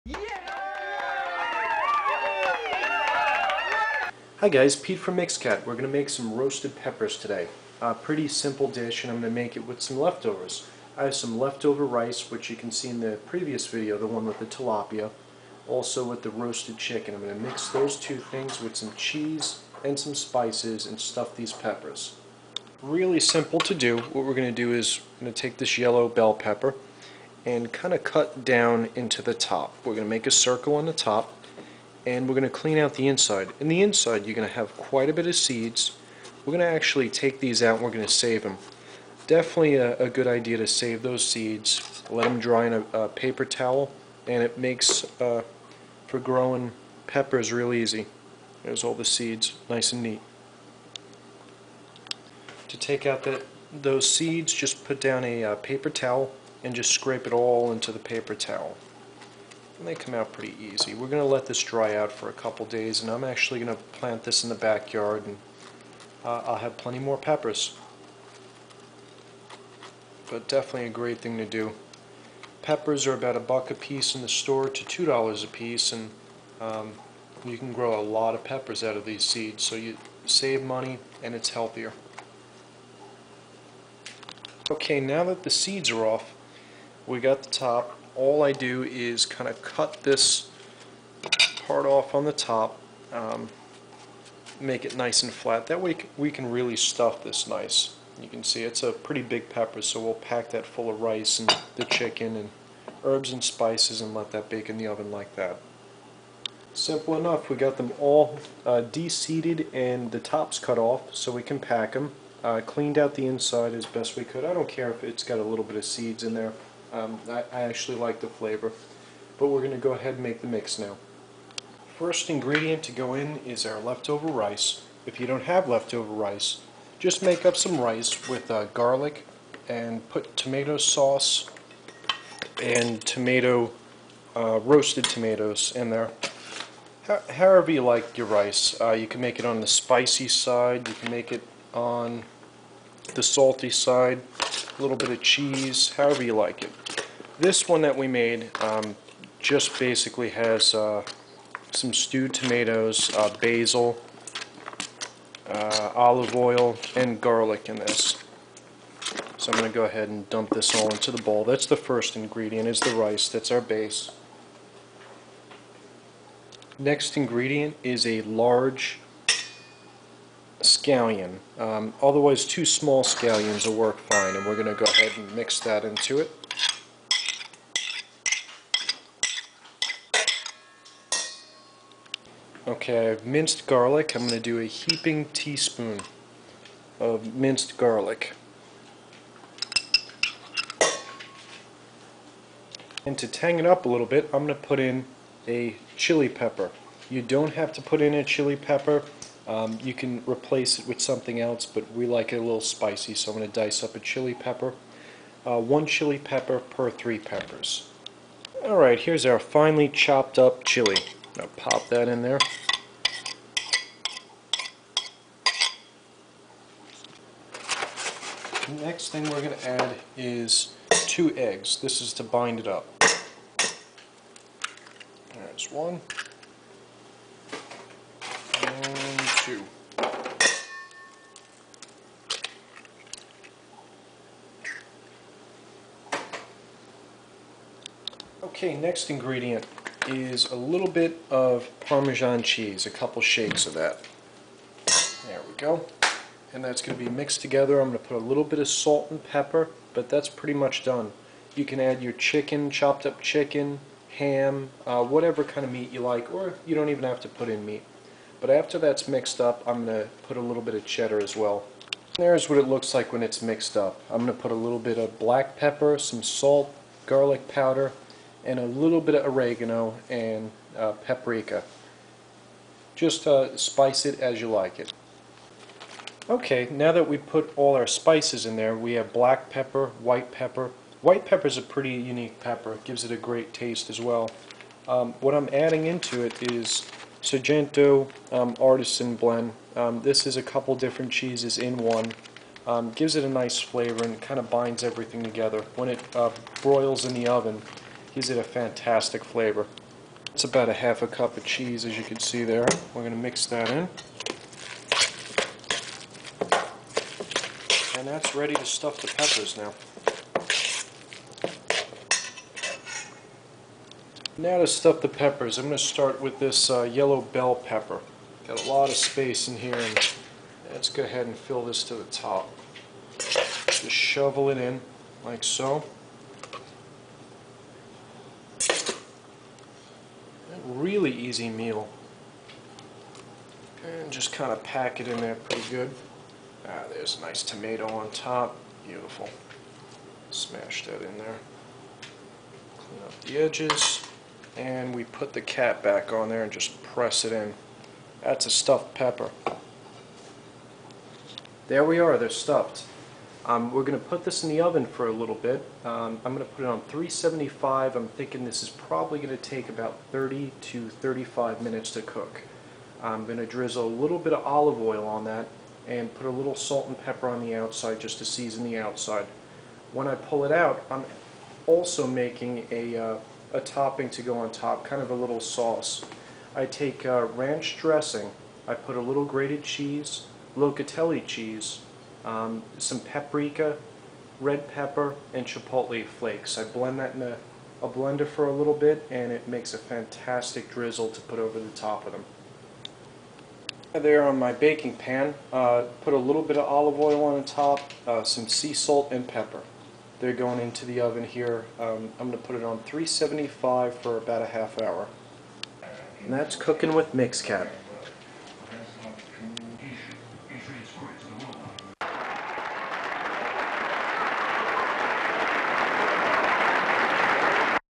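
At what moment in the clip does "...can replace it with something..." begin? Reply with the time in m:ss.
3:19.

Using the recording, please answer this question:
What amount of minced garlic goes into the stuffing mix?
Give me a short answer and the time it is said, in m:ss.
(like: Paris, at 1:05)
a heaping teaspoon, at 3:04.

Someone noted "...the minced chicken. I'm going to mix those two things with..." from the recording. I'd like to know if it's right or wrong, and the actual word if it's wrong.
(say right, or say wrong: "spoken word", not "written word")
wrong: "roasted", not "minced".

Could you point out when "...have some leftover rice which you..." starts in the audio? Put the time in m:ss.
0:11.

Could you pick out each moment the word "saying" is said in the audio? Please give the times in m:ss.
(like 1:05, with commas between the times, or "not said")
not said.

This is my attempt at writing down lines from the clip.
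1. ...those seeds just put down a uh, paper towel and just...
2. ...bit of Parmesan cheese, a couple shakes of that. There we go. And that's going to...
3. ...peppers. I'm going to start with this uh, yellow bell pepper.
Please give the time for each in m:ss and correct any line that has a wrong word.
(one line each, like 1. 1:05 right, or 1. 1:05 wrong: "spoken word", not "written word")
1. 0:53 right
2. 4:00 right
3. 5:15 right.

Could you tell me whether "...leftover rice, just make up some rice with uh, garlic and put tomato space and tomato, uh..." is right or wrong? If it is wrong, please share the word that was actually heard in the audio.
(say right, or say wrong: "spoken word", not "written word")
wrong: "sauce", not "space".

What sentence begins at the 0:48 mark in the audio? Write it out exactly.
There's all the seeds nice and neat.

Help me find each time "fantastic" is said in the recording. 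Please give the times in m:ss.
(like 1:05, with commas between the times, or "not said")
4:58, 6:29.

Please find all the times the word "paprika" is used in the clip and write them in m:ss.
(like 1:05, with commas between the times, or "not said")
4:30, 6:22.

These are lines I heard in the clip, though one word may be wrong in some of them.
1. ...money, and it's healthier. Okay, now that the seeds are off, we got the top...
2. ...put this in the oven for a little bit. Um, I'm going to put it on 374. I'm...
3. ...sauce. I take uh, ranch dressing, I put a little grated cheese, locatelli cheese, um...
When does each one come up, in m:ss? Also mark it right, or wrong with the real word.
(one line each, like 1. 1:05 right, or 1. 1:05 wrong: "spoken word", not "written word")
1. 1:20 right
2. 5:54 wrong: "375", not "374"
3. 6:15 right.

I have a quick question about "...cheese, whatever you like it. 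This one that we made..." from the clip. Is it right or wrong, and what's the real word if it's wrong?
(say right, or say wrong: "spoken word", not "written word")
wrong: "however", not "whatever".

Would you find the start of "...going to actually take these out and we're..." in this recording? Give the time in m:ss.
0:36.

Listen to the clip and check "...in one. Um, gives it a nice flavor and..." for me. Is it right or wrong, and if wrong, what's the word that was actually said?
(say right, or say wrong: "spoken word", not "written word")
right.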